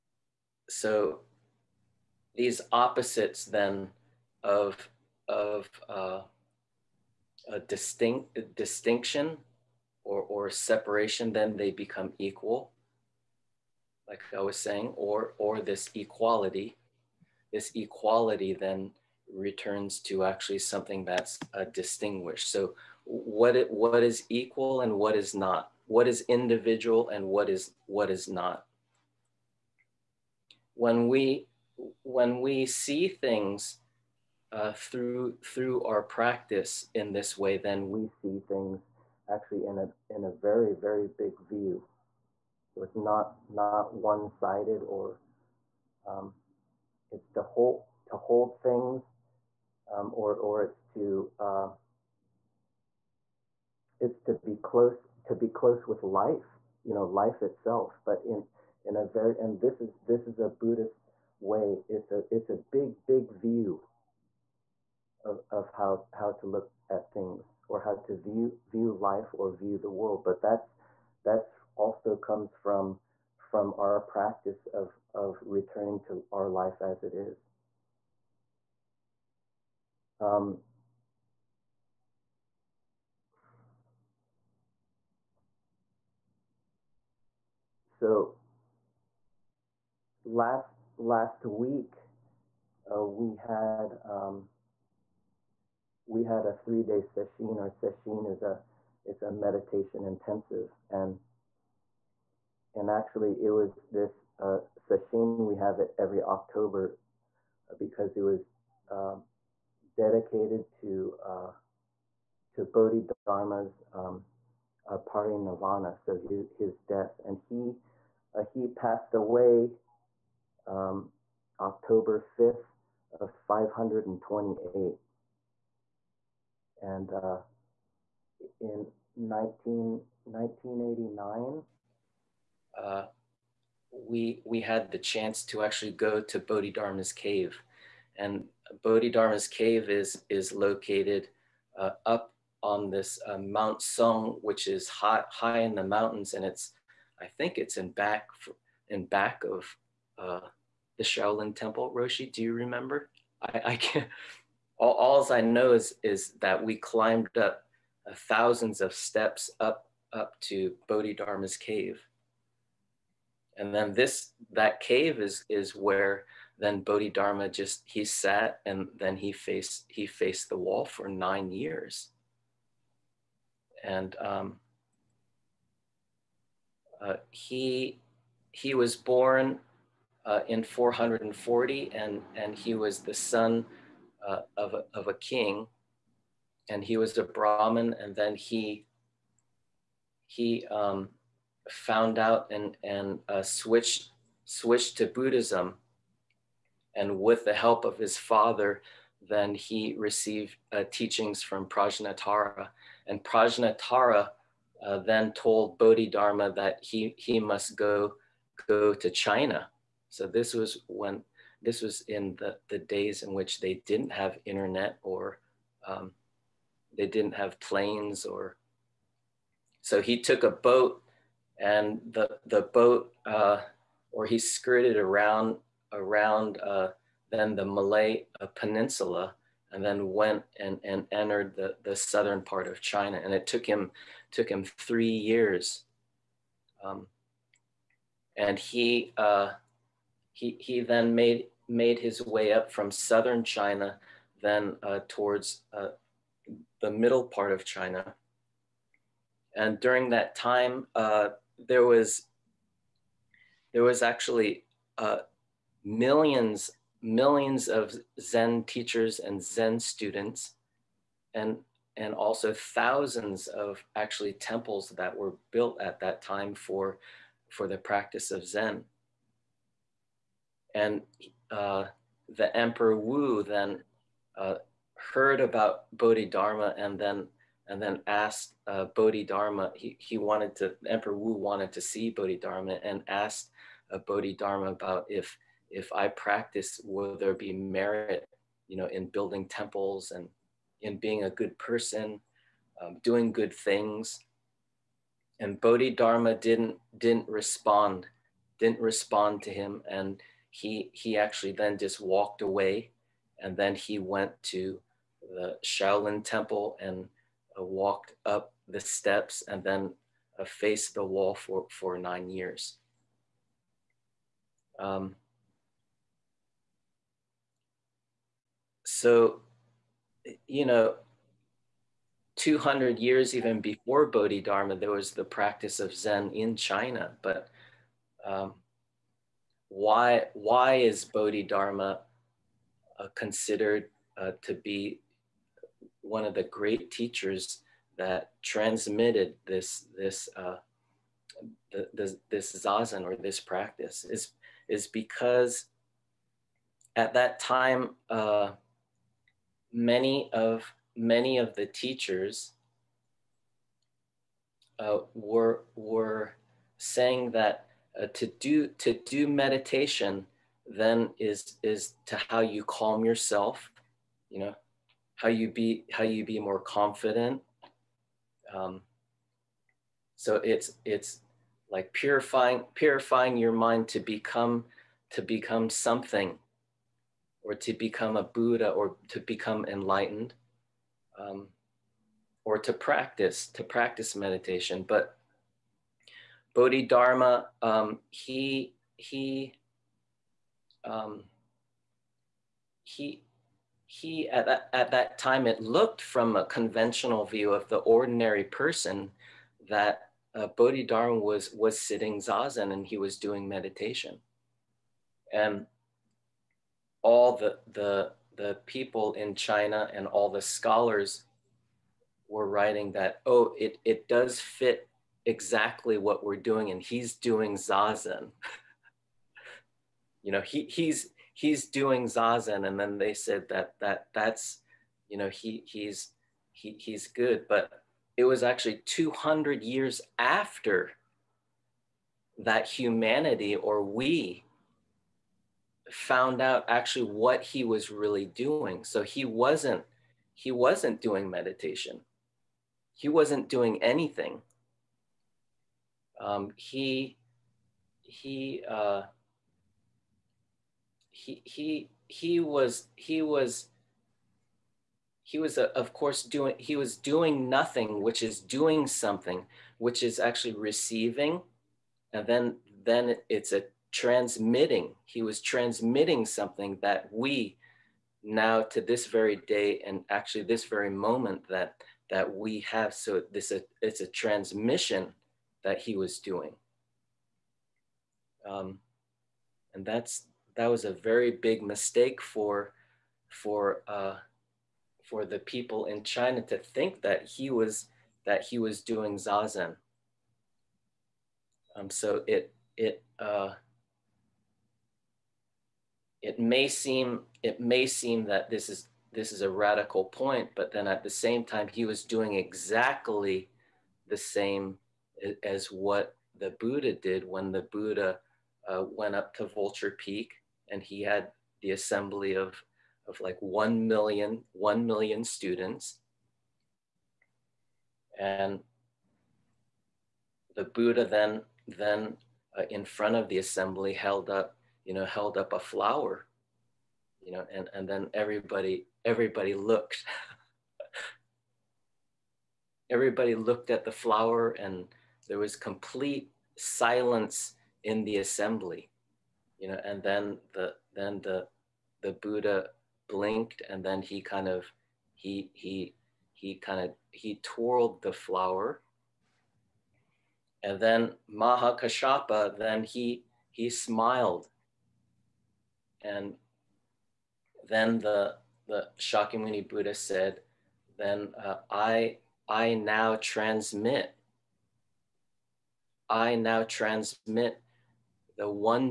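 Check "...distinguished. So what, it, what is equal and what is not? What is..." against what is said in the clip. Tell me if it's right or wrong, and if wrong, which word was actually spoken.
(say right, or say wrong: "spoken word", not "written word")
right.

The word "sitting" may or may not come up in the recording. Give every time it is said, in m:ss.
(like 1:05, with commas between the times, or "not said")
6:41.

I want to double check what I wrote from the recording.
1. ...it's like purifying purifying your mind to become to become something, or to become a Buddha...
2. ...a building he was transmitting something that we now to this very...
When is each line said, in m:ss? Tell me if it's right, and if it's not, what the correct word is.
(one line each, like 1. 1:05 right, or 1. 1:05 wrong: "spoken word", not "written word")
1. 6:10 right
2. 7:43 wrong: "transmitting", not "building".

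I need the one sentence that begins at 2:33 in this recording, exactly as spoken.
I, I can't, all, alls I know is, is that we climbed up of thousands of steps up, up to Bodhidharma's cave.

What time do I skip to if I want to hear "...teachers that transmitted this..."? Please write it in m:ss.
5:36.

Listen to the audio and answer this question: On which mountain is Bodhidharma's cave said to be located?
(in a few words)
Mount Sung.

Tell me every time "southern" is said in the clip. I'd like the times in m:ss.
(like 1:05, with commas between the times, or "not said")
3:51, 4:02.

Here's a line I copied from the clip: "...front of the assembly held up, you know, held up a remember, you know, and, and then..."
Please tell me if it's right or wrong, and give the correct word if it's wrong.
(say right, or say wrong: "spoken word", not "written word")
wrong: "flower", not "remember".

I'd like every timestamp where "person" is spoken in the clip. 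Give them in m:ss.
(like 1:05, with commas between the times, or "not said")
4:51, 6:38.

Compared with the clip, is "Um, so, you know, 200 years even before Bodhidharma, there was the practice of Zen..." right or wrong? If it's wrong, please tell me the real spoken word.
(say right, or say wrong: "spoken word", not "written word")
right.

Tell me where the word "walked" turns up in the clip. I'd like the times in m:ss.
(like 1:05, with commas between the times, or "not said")
5:02, 5:07.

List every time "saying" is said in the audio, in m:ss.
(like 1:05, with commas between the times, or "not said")
0:14, 5:56.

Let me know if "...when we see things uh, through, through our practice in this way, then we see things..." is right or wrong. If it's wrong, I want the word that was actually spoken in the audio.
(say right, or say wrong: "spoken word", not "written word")
right.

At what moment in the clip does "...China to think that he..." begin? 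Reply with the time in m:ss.
8:06.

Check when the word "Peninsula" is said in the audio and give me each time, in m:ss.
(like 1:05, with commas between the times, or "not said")
3:48.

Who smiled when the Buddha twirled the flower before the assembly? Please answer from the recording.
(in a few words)
Mahakashapa.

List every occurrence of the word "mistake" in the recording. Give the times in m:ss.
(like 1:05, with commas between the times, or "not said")
8:01.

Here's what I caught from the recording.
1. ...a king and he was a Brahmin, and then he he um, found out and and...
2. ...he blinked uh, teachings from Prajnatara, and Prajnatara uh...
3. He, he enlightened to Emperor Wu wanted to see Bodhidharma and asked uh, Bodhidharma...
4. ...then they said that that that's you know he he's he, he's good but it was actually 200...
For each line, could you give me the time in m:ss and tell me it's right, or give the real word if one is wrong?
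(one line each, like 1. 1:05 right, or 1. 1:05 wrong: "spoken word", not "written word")
1. 3:05 right
2. 3:19 wrong: "received", not "blinked"
3. 4:39 wrong: "wanted", not "enlightened"
4. 7:02 right.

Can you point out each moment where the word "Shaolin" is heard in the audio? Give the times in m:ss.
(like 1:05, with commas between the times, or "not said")
2:31, 5:05.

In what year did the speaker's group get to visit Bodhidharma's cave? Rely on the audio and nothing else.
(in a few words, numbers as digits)
1989.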